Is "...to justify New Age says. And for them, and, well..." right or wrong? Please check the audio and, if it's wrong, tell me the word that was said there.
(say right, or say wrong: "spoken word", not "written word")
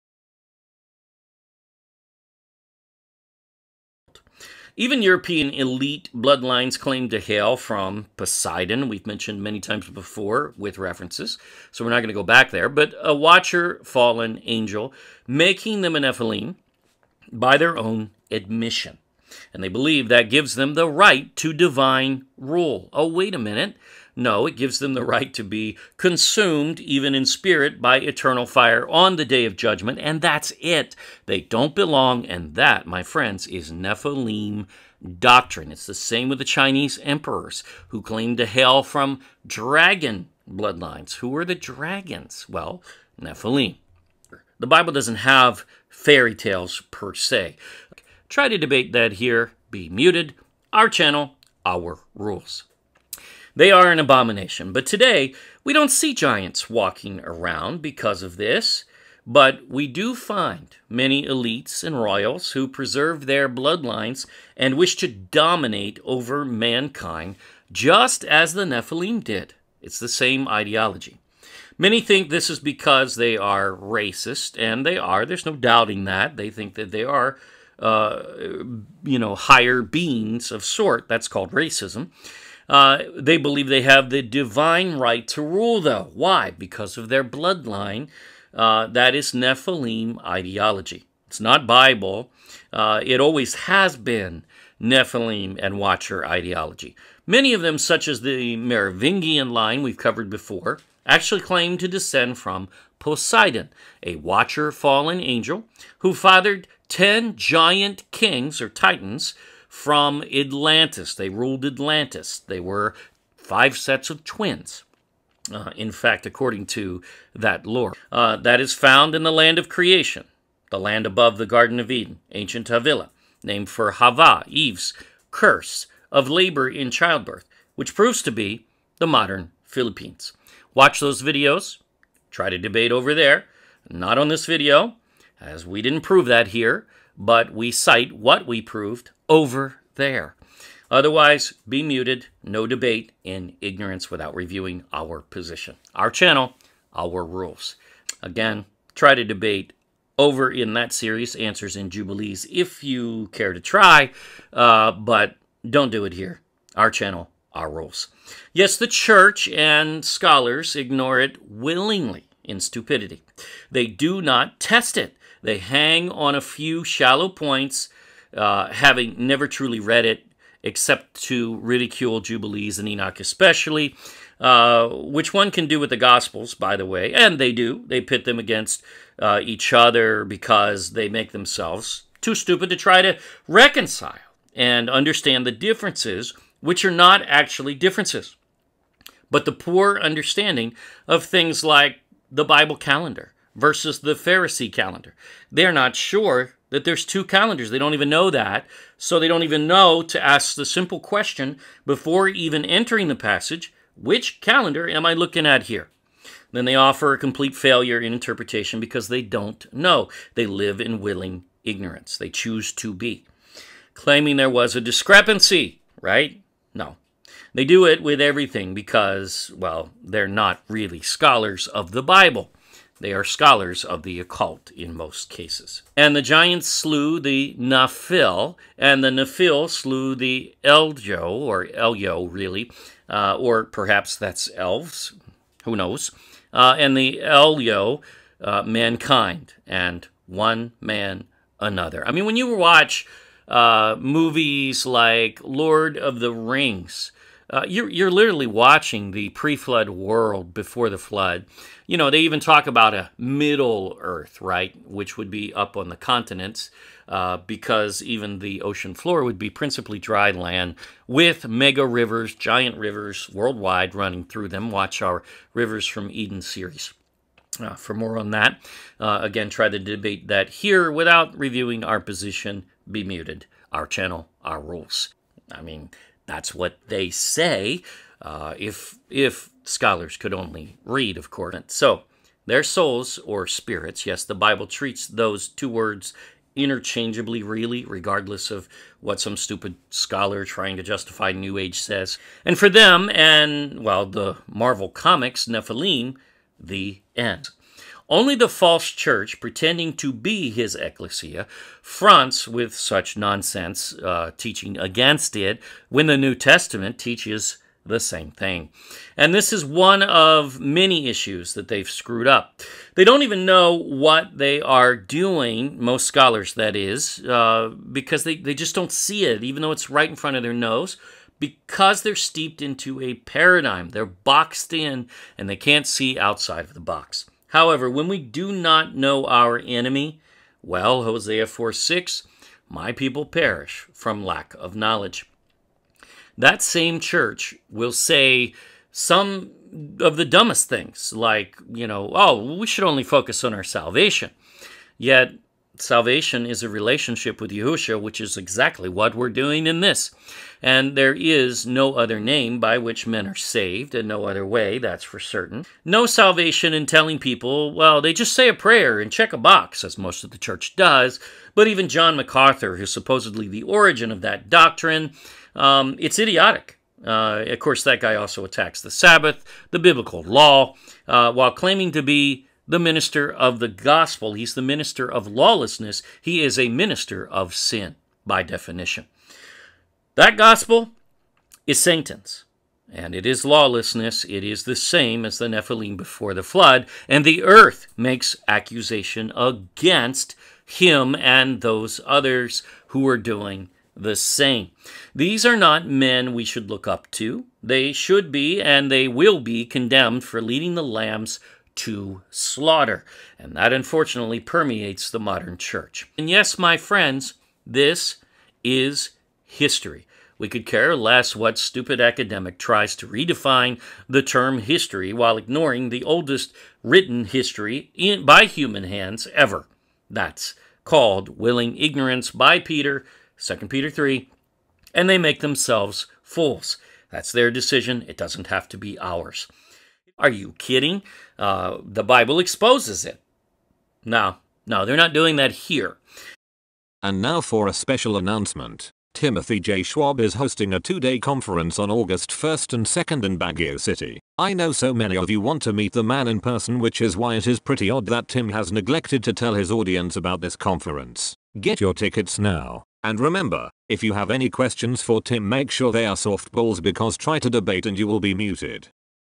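right.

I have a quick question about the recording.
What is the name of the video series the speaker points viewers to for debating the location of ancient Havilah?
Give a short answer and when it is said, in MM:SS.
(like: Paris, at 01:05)
Answers in Jubilees, at 02:31.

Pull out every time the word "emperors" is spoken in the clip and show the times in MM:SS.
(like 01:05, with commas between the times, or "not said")
00:37.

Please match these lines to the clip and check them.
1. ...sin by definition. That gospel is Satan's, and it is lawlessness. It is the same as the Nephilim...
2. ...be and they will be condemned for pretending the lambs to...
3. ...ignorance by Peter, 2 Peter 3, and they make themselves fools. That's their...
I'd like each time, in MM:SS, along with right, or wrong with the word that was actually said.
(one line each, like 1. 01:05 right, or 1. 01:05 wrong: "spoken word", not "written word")
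1. 06:17 right
2. 06:38 wrong: "leading", not "pretending"
3. 07:01 right.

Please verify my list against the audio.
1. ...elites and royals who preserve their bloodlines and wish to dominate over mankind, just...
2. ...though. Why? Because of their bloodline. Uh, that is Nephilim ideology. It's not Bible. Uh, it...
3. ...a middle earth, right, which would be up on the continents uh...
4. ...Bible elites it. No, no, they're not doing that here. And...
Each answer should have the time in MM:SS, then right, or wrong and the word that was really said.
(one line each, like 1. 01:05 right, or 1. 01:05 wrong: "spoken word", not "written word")
1. 01:01 right
2. 01:25 right
3. 04:12 right
4. 07:12 wrong: "exposes", not "elites".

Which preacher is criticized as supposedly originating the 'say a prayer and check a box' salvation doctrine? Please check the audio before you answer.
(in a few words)
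John MacArthur.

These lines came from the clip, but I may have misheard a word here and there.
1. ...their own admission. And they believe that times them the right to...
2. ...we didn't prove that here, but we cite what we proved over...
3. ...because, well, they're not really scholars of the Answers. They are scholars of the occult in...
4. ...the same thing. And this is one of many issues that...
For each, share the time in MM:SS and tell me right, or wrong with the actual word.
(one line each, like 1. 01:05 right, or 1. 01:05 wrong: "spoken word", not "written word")
1. 00:17 wrong: "gives", not "times"
2. 02:15 right
3. 03:38 wrong: "Bible", not "Answers"
4. 05:07 right.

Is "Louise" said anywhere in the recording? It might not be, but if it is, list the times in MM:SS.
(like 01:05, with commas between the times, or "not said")
not said.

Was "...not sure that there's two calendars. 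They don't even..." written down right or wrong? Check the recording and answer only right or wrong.
right.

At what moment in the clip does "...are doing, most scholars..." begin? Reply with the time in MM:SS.
05:14.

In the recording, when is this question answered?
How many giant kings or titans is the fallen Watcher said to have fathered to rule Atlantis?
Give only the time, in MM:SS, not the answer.
01:46.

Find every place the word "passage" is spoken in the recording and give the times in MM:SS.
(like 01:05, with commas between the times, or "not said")
03:23.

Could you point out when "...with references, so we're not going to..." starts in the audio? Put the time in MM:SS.
00:10.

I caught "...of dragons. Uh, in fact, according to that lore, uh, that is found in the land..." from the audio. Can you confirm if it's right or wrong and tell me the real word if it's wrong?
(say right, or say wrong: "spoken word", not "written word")
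wrong: "twins", not "dragons".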